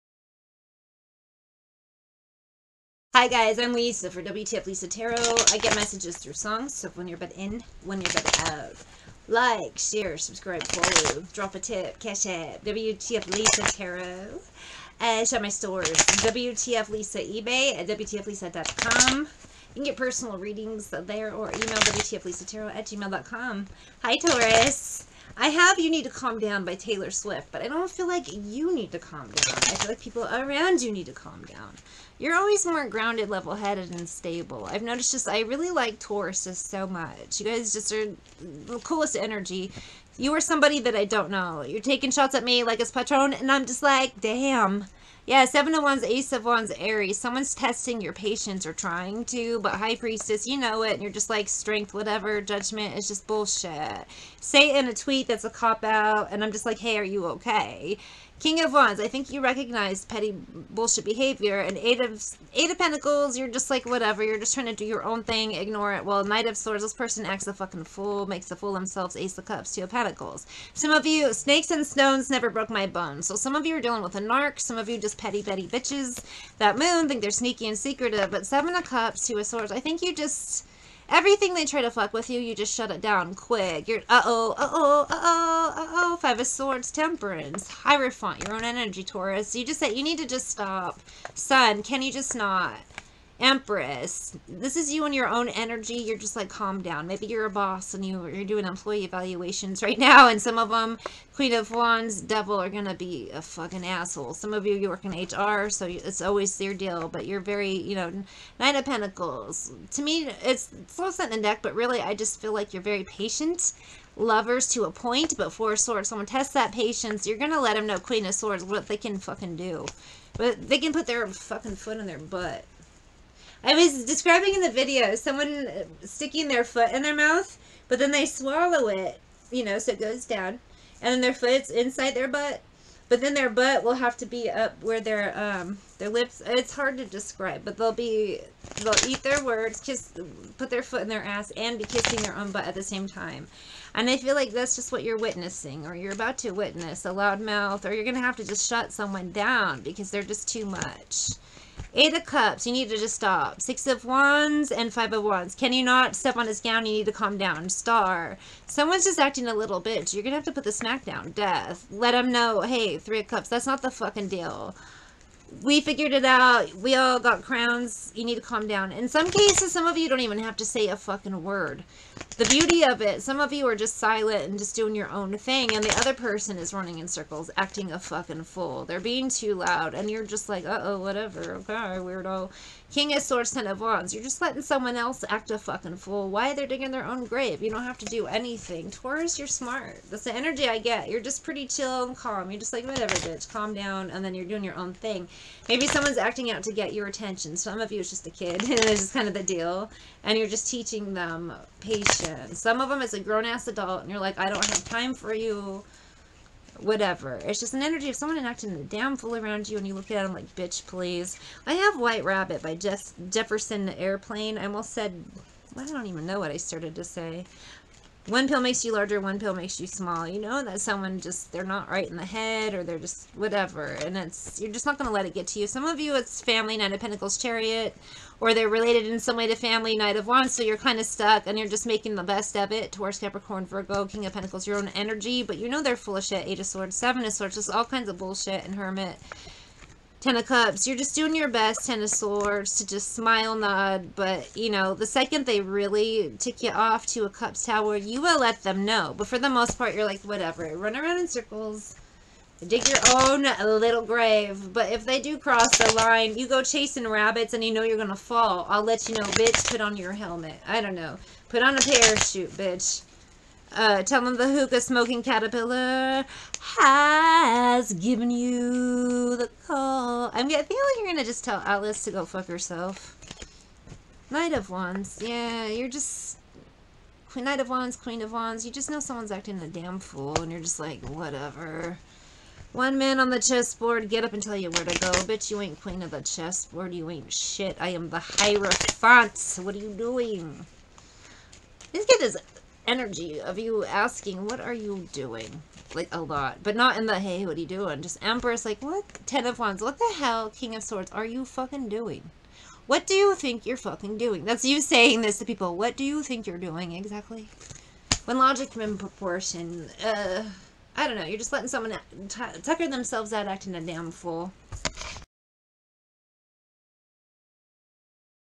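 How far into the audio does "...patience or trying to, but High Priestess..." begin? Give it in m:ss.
0:48.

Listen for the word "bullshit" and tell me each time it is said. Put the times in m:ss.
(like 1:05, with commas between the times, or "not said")
0:53, 1:00, 3:58.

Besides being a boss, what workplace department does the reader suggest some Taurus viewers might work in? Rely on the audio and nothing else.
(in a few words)
HR.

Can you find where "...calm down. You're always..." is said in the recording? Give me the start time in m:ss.
0:31.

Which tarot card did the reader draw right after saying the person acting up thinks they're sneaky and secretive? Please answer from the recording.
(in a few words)
Seven of Cups.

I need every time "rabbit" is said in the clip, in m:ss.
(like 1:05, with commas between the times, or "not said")
3:32, 4:17.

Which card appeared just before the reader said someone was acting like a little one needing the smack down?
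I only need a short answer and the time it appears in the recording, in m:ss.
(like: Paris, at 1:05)
Star, at 2:37.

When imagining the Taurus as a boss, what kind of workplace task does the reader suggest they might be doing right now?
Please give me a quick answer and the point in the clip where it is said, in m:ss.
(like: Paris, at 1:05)
employee evaluations, at 1:38.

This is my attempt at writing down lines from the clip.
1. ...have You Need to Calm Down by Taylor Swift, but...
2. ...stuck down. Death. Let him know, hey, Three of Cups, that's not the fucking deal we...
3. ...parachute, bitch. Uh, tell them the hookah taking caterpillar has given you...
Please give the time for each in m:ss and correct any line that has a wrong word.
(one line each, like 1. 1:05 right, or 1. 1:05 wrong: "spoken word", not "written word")
1. 0:25 right
2. 2:40 wrong: "smack", not "stuck"
3. 4:21 wrong: "smoking", not "taking".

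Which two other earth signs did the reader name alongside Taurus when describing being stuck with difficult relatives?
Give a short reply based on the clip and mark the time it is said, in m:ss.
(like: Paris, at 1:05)
Capricorn, Virgo, at 3:53.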